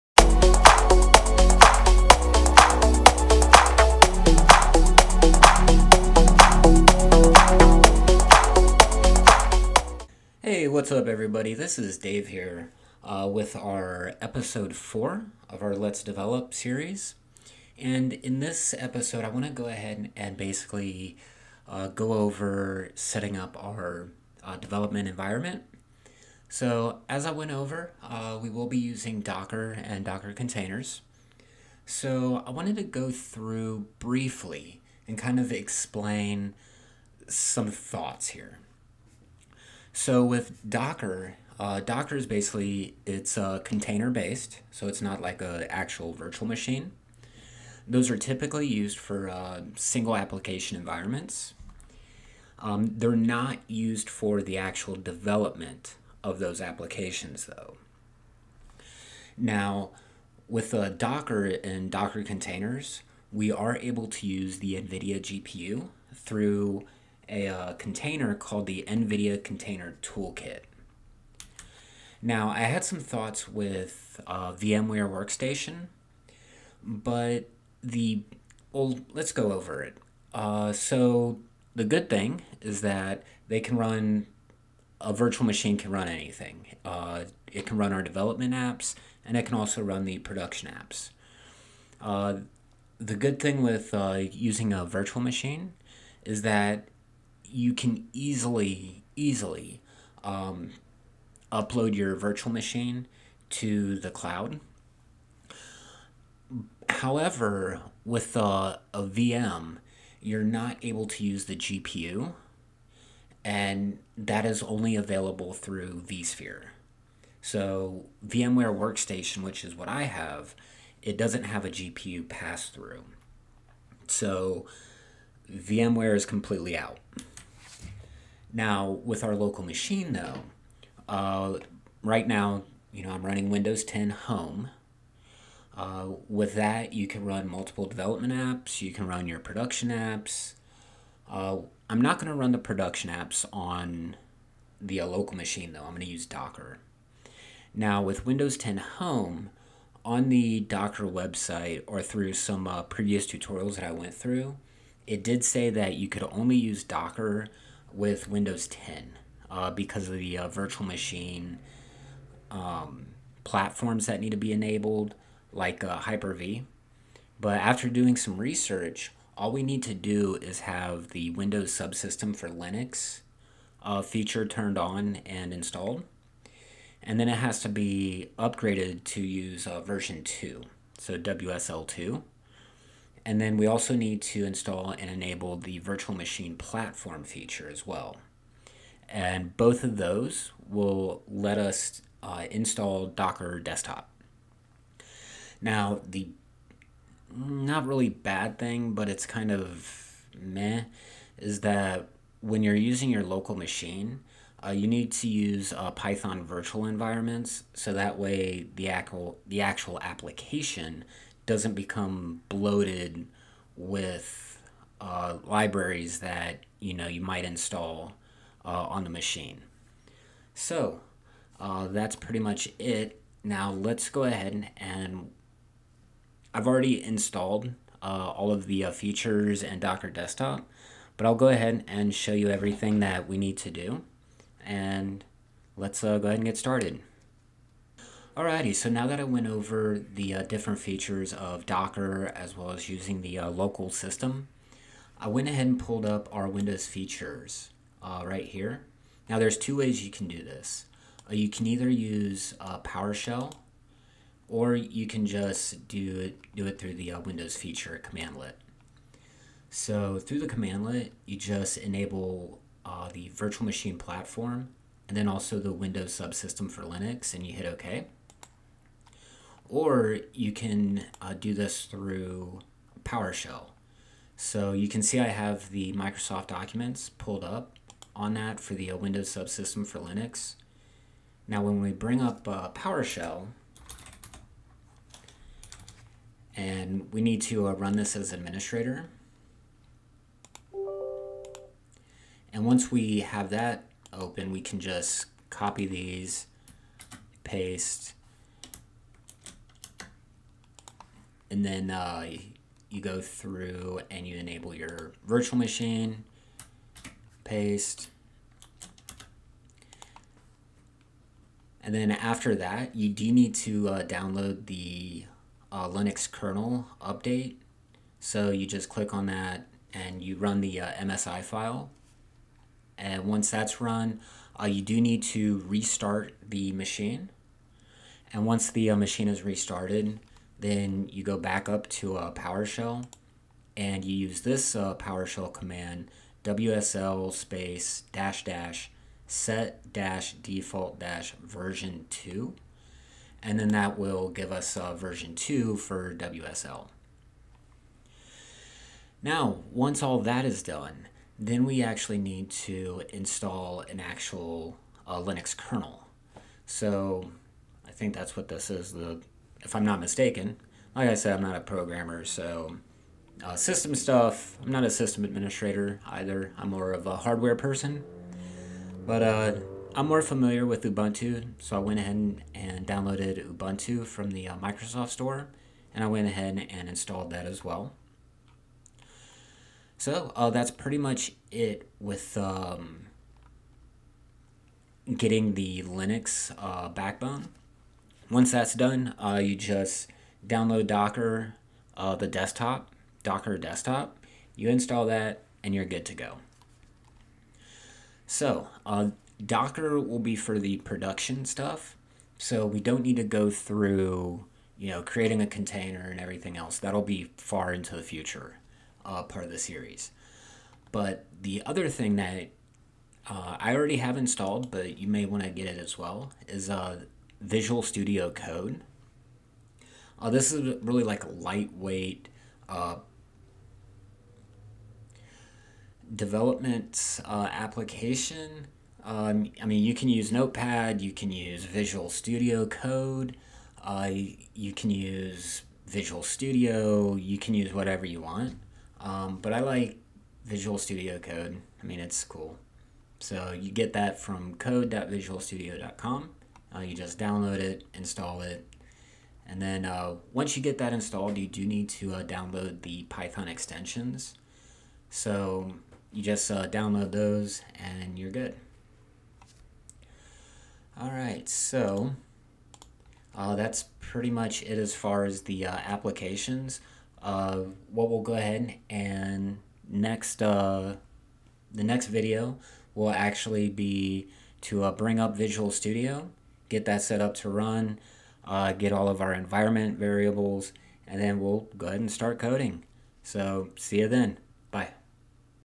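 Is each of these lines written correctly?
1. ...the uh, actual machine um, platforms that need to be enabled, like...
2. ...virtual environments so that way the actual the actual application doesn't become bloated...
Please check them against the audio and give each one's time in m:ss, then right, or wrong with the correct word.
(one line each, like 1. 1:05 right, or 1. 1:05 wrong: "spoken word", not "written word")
1. 2:40 wrong: "virtual", not "actual"
2. 3:26 right.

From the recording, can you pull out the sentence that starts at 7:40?
All right, so uh, that's pretty much it as far as the uh, applications.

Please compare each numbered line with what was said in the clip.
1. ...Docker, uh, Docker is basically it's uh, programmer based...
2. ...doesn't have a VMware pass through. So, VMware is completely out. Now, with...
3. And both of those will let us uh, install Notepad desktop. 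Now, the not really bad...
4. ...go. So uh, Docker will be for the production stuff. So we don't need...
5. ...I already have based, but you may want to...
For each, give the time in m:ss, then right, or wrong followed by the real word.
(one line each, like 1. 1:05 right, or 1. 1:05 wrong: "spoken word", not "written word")
1. 0:40 wrong: "container", not "programmer"
2. 2:01 wrong: "GPU", not "VMware"
3. 3:09 wrong: "Docker", not "Notepad"
4. 6:36 right
5. 6:53 wrong: "installed", not "based".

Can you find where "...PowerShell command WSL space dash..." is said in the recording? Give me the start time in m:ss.
5:34.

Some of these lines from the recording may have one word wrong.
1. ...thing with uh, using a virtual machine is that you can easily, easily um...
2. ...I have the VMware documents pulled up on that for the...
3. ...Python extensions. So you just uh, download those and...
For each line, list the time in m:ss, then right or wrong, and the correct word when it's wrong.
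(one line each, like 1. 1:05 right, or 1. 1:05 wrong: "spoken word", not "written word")
1. 1:33 right
2. 4:35 wrong: "Microsoft", not "VMware"
3. 7:33 right.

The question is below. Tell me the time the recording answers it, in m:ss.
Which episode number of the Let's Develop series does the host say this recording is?
0:14.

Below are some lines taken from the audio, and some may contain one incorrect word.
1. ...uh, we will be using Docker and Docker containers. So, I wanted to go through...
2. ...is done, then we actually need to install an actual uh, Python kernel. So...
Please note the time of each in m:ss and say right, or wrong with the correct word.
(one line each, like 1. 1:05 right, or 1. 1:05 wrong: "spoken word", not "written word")
1. 0:28 right
2. 5:50 wrong: "Linux", not "Python".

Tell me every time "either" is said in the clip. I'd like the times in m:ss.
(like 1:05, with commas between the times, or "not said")
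4:11, 6:06.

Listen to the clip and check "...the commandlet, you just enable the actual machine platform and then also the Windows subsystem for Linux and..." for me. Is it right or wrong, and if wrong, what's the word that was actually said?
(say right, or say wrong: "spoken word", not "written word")
wrong: "virtual", not "actual".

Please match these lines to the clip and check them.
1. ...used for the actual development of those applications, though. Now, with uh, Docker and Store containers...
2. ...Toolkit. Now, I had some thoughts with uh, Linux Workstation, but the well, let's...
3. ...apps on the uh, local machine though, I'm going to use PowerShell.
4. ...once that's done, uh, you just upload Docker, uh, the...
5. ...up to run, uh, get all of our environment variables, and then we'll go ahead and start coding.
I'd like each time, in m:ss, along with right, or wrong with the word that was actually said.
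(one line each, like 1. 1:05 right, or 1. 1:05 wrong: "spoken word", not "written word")
1. 0:53 wrong: "Docker", not "Store"
2. 1:10 wrong: "VMware", not "Linux"
3. 2:23 wrong: "Docker", not "PowerShell"
4. 6:28 wrong: "download", not "upload"
5. 7:57 right.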